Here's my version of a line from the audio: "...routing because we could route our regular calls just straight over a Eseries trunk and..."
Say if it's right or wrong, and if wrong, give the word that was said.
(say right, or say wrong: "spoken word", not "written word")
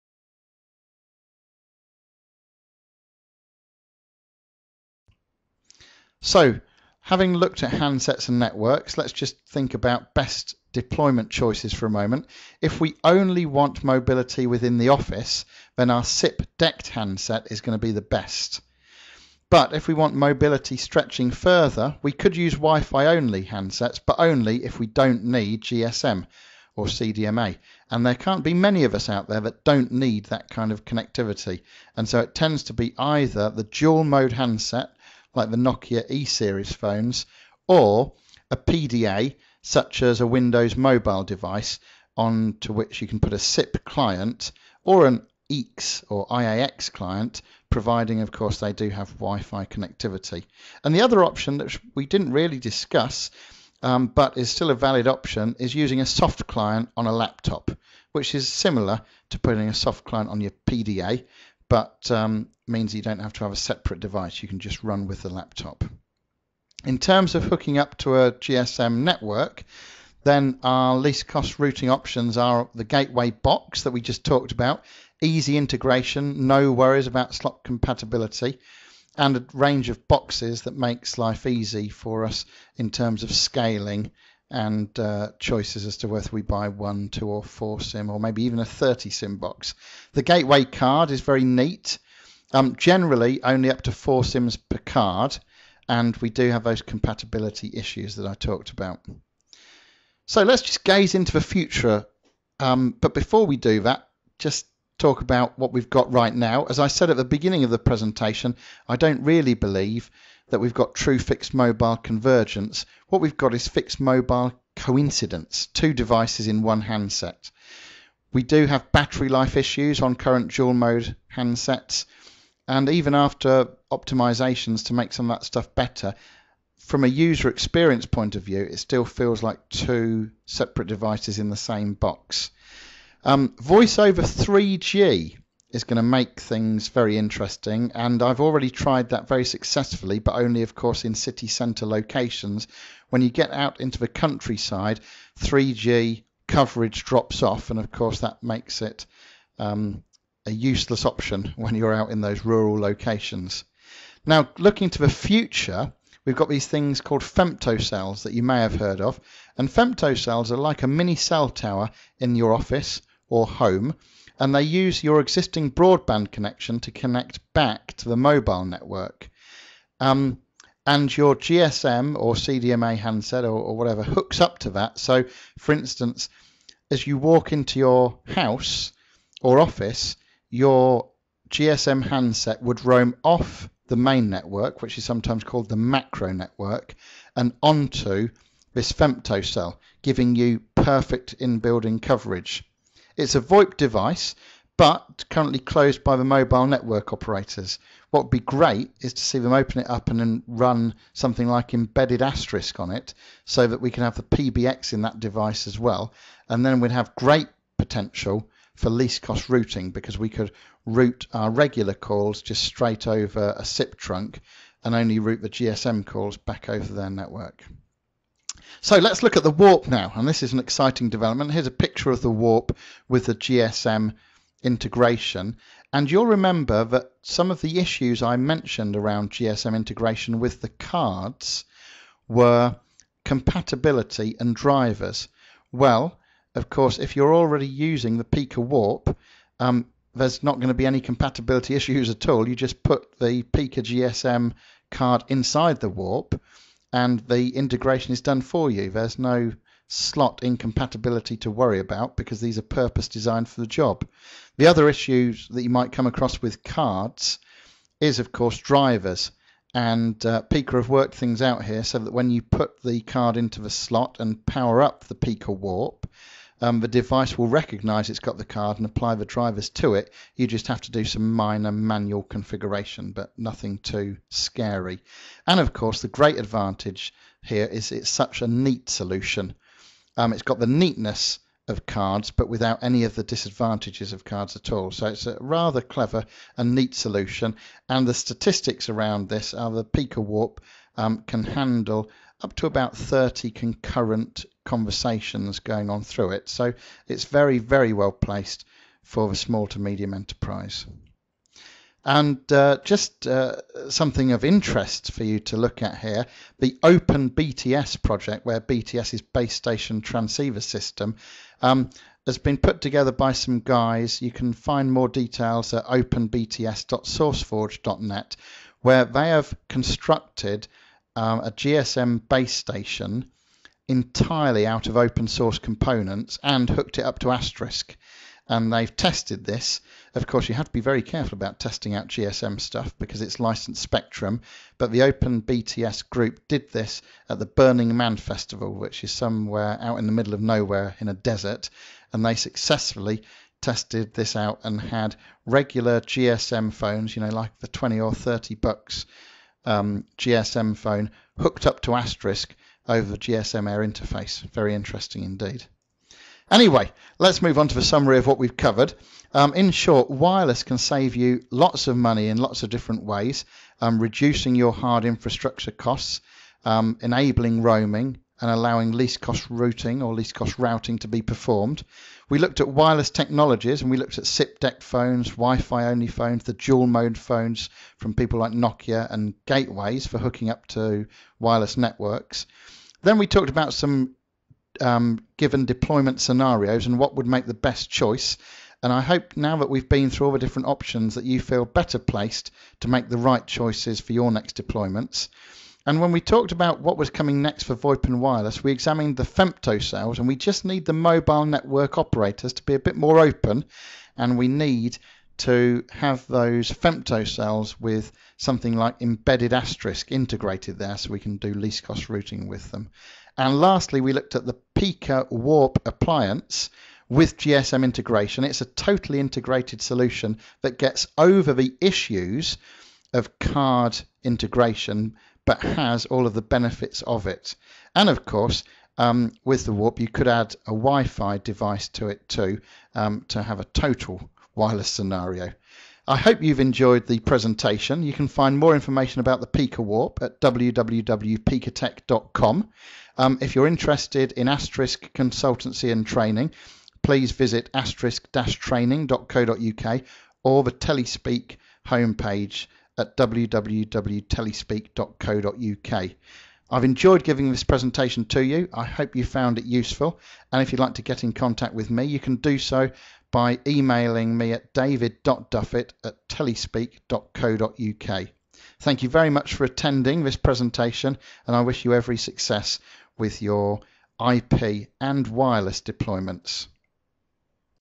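wrong: "SIP", not "Eseries".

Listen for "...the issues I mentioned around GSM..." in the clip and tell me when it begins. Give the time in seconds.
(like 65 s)
227 s.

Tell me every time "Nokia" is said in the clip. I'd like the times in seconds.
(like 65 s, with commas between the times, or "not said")
35 s, 378 s.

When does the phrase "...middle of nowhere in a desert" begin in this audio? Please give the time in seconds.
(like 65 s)
340 s.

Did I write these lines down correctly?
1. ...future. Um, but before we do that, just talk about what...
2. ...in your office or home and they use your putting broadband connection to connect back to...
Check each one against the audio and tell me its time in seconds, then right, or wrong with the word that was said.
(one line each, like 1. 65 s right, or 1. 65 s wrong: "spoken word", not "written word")
1. 101 s right
2. 162 s wrong: "existing", not "putting".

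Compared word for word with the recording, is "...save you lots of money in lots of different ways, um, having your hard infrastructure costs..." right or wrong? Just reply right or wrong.
wrong.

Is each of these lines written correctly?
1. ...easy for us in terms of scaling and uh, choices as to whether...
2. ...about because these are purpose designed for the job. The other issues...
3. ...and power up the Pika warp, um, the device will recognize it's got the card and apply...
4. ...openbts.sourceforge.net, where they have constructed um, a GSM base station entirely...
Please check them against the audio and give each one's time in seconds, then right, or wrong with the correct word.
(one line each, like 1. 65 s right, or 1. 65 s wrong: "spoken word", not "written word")
1. 81 s right
2. 251 s right
3. 264 s right
4. 315 s right.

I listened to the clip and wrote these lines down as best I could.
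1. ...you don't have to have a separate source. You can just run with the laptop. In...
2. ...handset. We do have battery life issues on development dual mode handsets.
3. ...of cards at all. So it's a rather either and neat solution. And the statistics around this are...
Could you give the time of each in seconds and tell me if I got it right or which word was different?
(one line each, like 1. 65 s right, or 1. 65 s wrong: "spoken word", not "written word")
1. 62 s wrong: "device", not "source"
2. 116 s wrong: "current", not "development"
3. 284 s wrong: "clever", not "either".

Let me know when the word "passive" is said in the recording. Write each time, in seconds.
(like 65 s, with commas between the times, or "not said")
not said.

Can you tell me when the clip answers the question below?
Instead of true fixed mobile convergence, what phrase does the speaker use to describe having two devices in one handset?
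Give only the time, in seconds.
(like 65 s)
113 s.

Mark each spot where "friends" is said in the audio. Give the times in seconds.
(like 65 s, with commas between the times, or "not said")
not said.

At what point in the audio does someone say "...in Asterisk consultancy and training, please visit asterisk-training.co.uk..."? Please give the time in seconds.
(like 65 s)
444 s.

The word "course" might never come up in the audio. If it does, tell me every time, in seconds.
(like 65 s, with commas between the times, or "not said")
48 s, 140 s, 147 s, 236 s, 258 s, 275 s, 330 s, 428 s.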